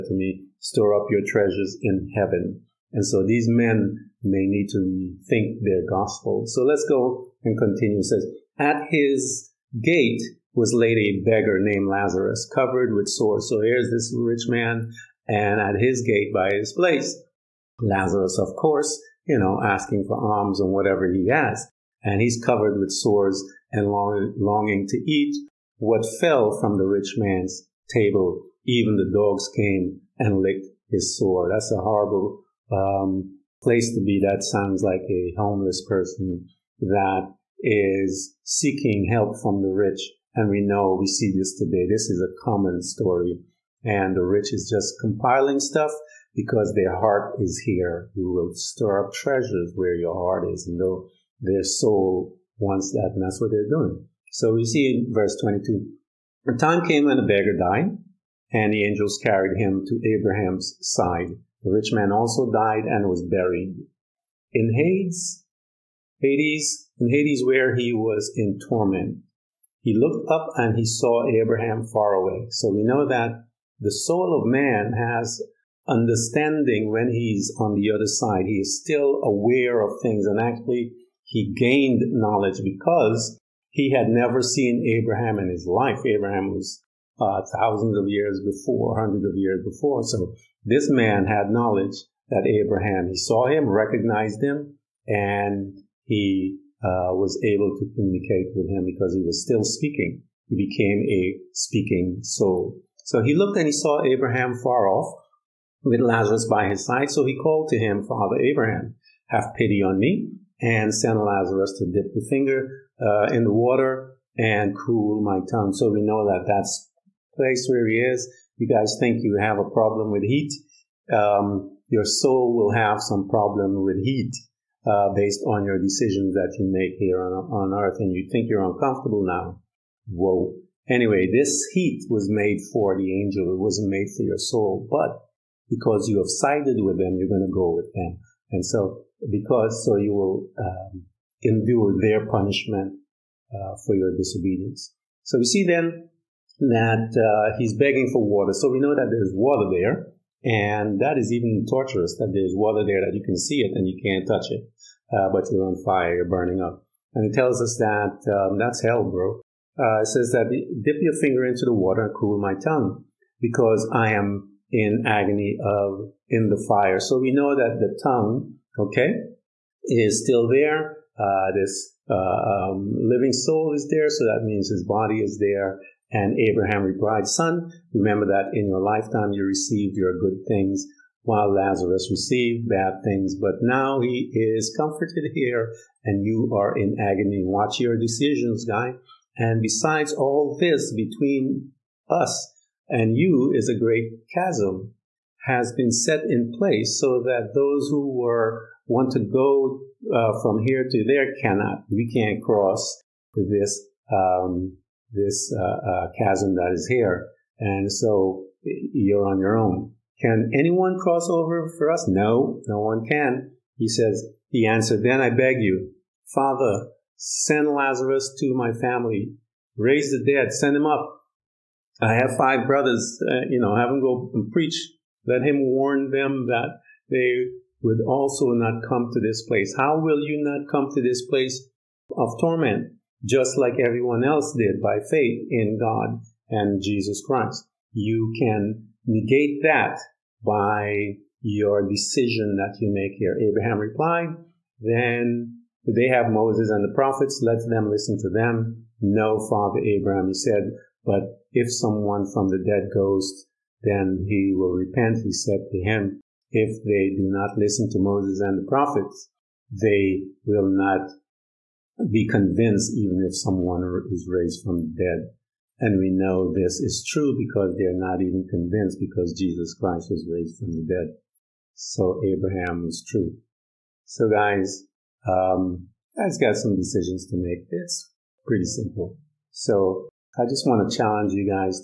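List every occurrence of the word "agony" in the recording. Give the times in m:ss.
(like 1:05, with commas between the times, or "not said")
2:45, 3:06.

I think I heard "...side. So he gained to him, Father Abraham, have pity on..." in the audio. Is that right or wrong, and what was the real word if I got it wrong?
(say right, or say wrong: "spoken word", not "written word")
wrong: "called", not "gained".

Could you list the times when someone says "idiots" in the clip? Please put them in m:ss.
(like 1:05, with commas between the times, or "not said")
not said.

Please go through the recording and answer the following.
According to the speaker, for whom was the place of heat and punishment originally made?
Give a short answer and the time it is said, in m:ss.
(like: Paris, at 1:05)
The angel, at 2:12.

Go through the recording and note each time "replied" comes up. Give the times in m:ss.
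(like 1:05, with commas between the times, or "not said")
2:56, 4:03.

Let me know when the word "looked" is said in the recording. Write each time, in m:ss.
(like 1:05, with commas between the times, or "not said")
1:09, 1:43.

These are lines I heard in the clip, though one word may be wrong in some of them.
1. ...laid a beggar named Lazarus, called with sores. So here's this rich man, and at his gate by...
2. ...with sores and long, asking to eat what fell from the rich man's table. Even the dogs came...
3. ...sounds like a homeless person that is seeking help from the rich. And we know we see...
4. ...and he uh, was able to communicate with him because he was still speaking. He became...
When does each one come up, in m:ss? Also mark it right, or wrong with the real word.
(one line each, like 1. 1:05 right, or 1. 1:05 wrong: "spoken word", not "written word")
1. 0:10 wrong: "covered", not "called"
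2. 0:22 wrong: "longing", not "asking"
3. 0:34 right
4. 1:35 right.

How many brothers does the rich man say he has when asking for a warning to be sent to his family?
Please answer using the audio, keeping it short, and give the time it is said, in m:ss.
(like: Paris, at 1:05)
5, at 3:42.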